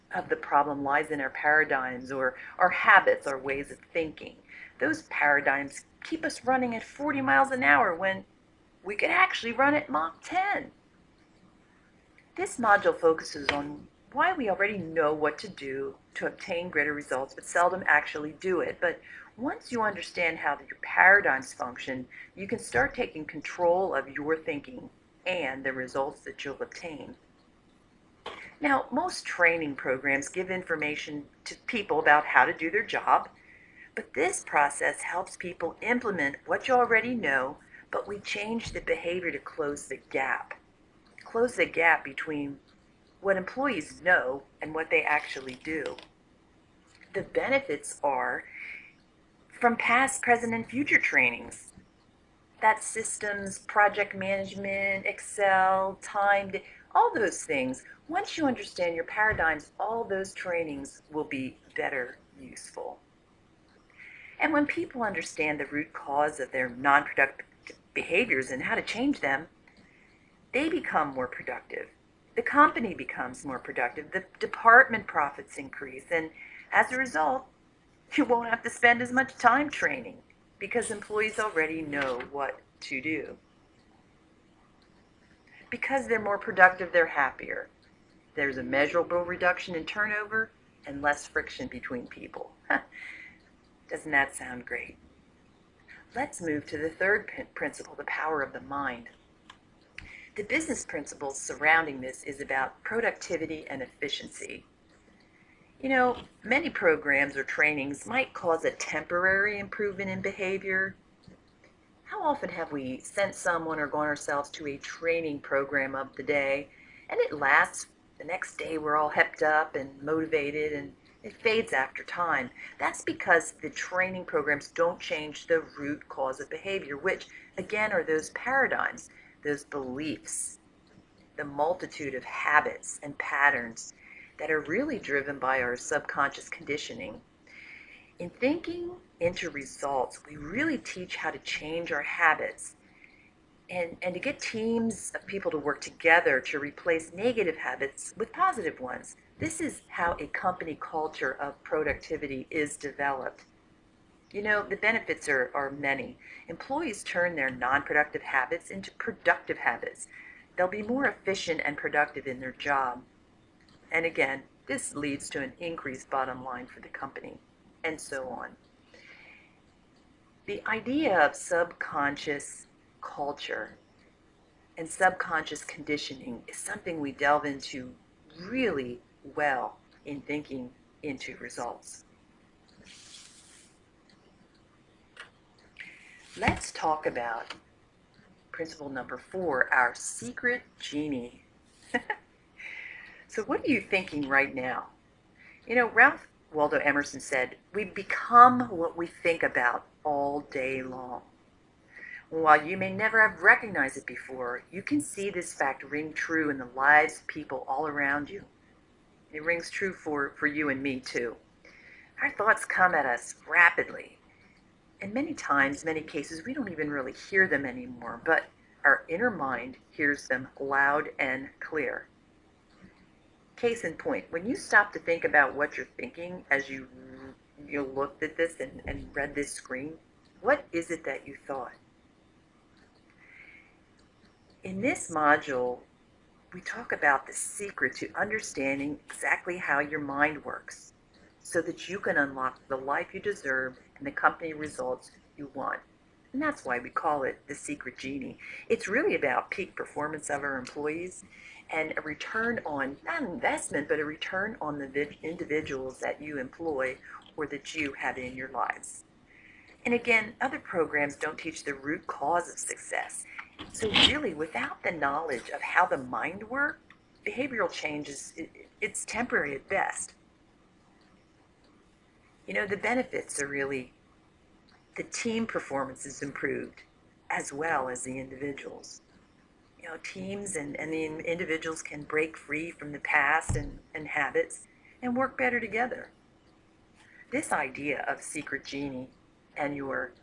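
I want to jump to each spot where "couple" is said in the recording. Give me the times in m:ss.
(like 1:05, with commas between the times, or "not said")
not said.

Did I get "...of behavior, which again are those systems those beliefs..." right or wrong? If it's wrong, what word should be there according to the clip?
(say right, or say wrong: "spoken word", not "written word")
wrong: "paradigms", not "systems".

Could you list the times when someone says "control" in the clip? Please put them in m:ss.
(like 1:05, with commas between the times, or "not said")
0:23.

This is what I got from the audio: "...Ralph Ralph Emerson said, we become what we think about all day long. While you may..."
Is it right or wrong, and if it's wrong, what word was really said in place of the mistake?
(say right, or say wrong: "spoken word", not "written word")
wrong: "Waldo", not "Ralph".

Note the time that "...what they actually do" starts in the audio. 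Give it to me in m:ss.
0:44.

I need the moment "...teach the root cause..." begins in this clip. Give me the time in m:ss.
4:21.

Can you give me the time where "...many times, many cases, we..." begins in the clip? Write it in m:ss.
3:35.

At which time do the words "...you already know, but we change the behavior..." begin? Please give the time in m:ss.
0:36.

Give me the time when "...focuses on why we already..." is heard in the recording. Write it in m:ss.
0:12.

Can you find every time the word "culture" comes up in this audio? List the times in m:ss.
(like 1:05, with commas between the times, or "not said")
2:30, 2:52.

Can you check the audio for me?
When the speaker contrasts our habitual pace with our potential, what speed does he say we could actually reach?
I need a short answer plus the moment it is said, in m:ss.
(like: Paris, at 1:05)
Mach 10, at 0:09.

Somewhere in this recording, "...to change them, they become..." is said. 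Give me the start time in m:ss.
1:08.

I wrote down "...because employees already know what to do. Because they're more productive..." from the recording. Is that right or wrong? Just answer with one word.
right.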